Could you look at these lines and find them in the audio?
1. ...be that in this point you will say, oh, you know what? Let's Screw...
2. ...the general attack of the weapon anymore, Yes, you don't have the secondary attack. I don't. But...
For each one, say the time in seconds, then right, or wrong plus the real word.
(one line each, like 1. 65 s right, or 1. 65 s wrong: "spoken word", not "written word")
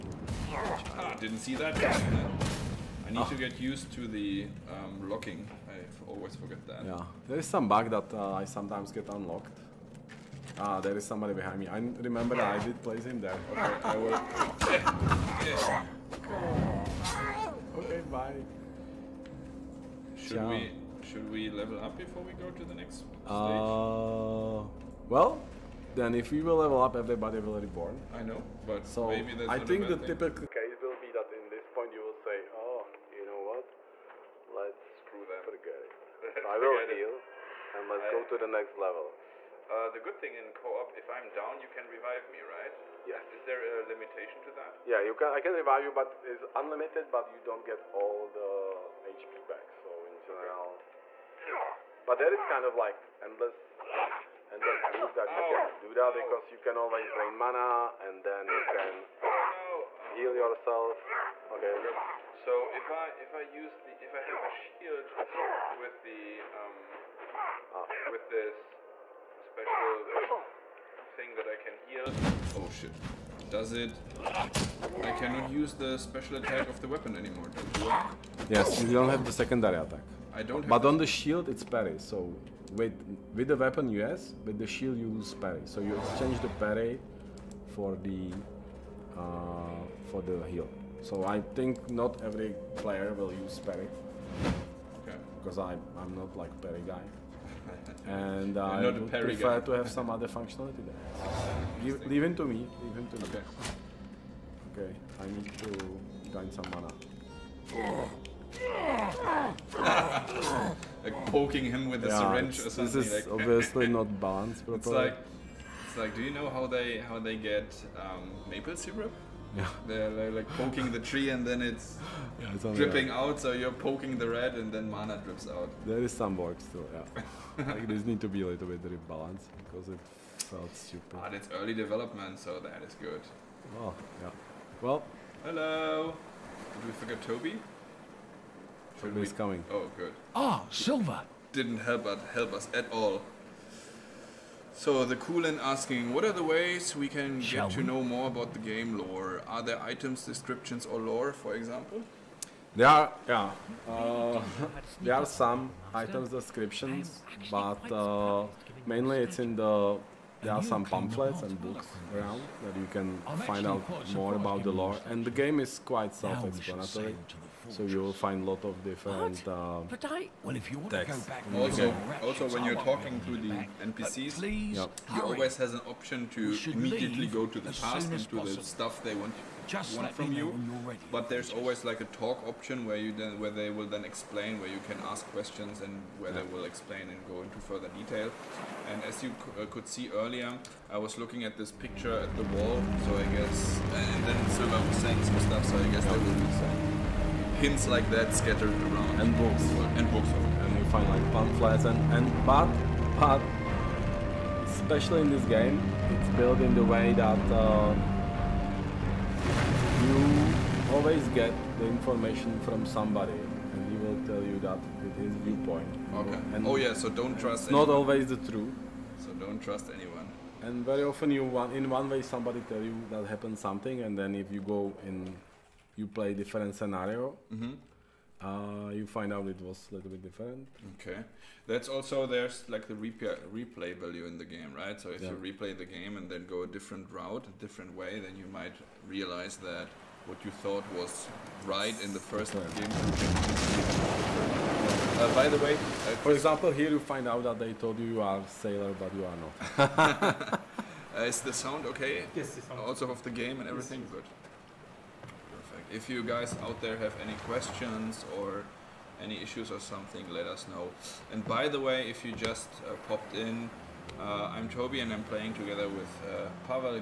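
1. 31 s right
2. 75 s wrong: "special", not "general".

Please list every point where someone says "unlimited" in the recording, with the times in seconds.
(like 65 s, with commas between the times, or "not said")
46 s.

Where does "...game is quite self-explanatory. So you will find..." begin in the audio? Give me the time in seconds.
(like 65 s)
165 s.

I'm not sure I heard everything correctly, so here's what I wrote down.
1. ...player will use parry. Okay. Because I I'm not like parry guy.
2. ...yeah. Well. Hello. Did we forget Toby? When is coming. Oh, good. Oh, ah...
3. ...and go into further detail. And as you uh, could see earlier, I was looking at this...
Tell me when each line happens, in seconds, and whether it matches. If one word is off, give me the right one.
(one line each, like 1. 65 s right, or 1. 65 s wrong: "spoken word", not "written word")
1. 92 s right
2. 134 s right
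3. 187 s right.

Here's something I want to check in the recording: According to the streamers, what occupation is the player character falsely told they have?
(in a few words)
Sailor.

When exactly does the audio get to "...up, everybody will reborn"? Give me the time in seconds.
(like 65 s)
26 s.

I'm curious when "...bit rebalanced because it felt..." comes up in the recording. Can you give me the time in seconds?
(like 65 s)
128 s.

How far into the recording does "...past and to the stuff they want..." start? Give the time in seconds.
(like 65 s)
177 s.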